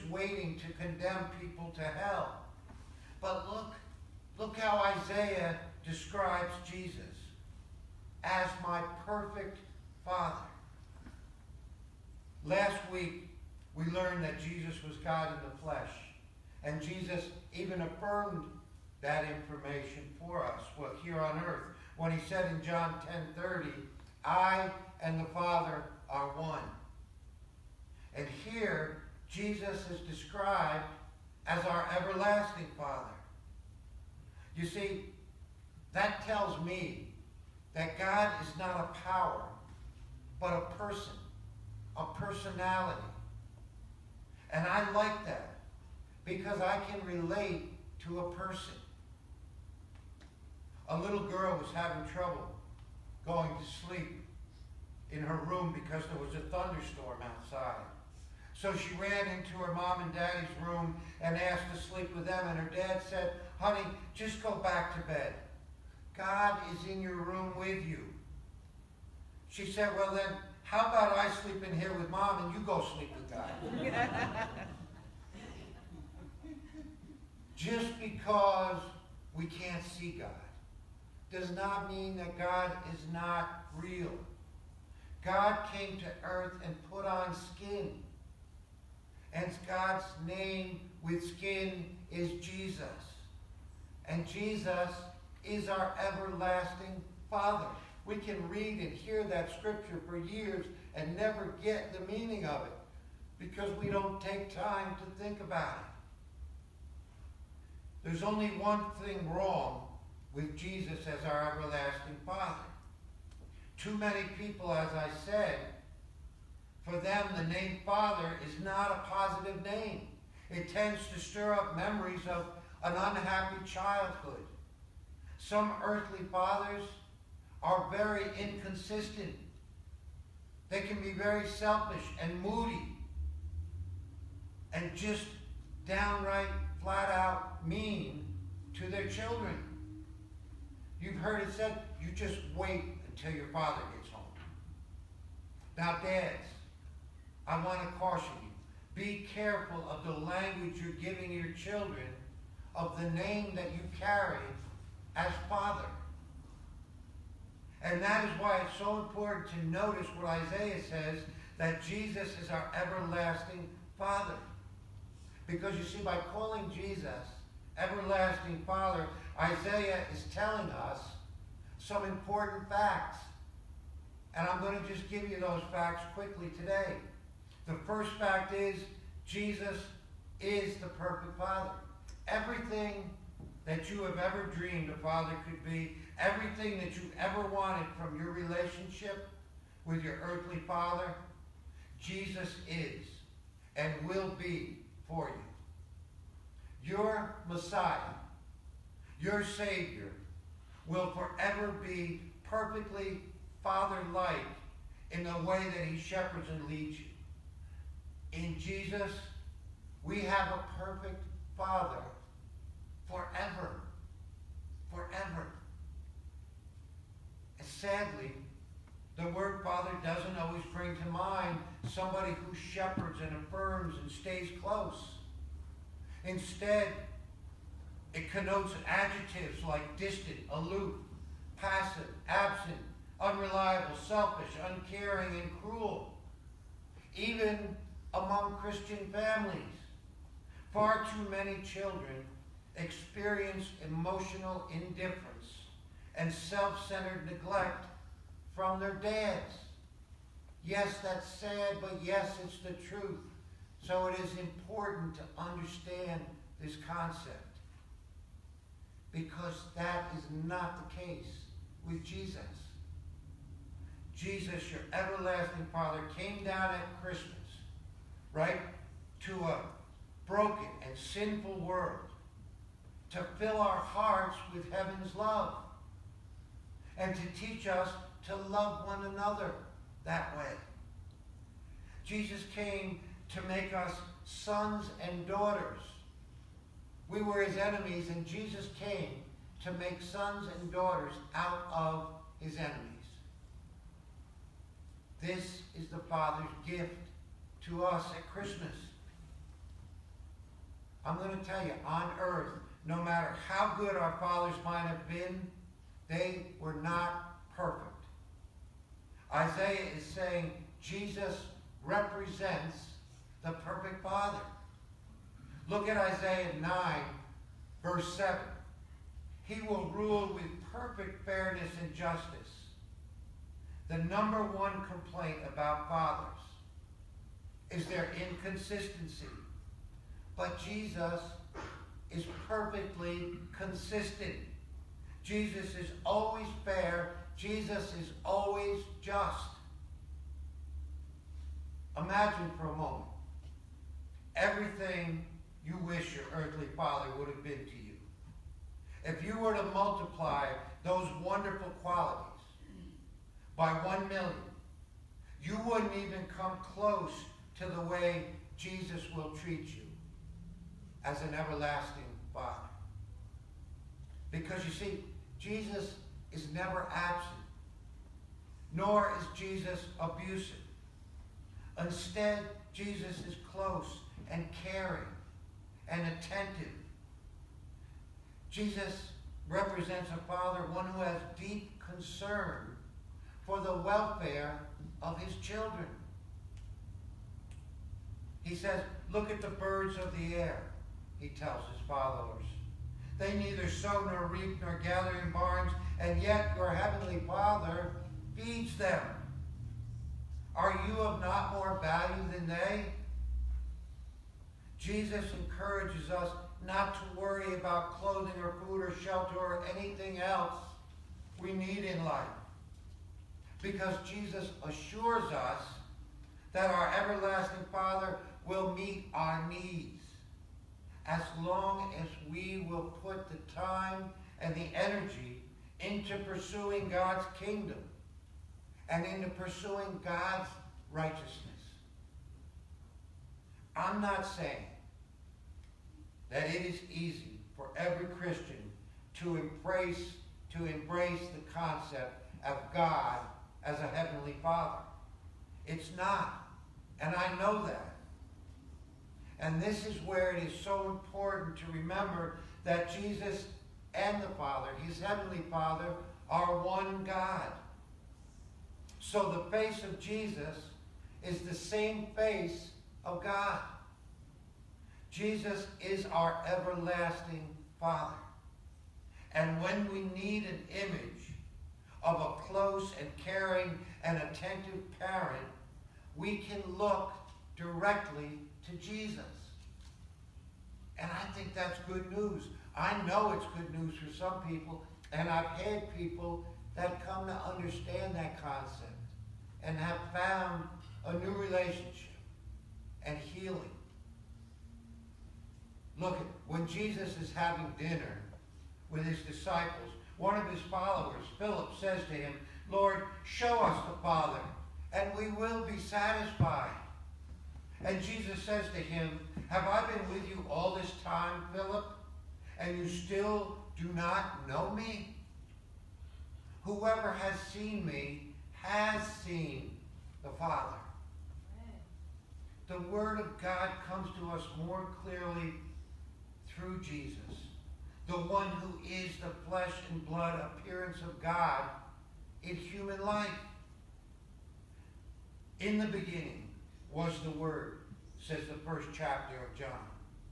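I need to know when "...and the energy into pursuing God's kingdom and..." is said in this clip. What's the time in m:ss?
7:04.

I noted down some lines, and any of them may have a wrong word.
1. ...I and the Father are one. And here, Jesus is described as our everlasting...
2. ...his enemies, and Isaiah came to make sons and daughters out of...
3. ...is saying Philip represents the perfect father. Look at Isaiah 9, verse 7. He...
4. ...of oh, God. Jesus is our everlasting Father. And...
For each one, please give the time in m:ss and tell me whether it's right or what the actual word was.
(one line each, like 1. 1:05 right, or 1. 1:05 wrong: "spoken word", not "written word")
1. 0:24 right
2. 4:47 wrong: "Jesus", not "Isaiah"
3. 5:09 wrong: "Jesus", not "Philip"
4. 7:43 right.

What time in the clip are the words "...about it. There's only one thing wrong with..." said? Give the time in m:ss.
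1:45.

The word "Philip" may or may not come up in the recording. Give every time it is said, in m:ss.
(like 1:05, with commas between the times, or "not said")
8:21, 8:31.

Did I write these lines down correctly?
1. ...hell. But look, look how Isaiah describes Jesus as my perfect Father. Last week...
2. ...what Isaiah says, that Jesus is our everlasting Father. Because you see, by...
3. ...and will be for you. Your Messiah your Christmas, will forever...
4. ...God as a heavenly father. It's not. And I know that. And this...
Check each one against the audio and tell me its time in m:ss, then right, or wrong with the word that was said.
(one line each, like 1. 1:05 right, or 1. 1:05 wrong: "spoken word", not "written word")
1. 0:01 right
2. 2:40 right
3. 3:13 wrong: "Savior", not "Christmas"
4. 7:22 right.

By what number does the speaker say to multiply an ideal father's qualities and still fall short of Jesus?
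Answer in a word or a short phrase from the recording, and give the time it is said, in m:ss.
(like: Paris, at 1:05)
1 million, at 5:53.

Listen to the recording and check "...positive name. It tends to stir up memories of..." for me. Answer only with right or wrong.
right.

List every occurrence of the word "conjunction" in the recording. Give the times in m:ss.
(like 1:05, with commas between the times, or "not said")
not said.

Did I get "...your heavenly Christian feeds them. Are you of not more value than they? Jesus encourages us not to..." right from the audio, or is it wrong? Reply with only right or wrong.
wrong.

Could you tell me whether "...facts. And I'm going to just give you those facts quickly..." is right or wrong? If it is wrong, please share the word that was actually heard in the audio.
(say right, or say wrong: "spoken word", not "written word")
right.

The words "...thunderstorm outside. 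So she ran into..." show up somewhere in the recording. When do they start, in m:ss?
0:56.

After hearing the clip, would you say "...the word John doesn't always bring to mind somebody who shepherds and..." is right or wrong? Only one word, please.
wrong.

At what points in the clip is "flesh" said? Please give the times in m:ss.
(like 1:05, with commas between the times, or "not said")
0:15, 8:49.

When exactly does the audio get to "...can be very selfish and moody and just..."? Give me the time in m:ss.
2:10.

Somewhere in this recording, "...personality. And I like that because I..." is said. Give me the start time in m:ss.
0:42.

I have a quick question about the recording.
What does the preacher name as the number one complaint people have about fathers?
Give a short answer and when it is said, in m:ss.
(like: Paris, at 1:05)
Inconsistency, at 5:28.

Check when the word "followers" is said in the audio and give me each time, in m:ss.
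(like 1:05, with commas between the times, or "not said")
6:31, 8:20.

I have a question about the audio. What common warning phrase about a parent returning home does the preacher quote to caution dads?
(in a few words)
You just wait until your father gets home.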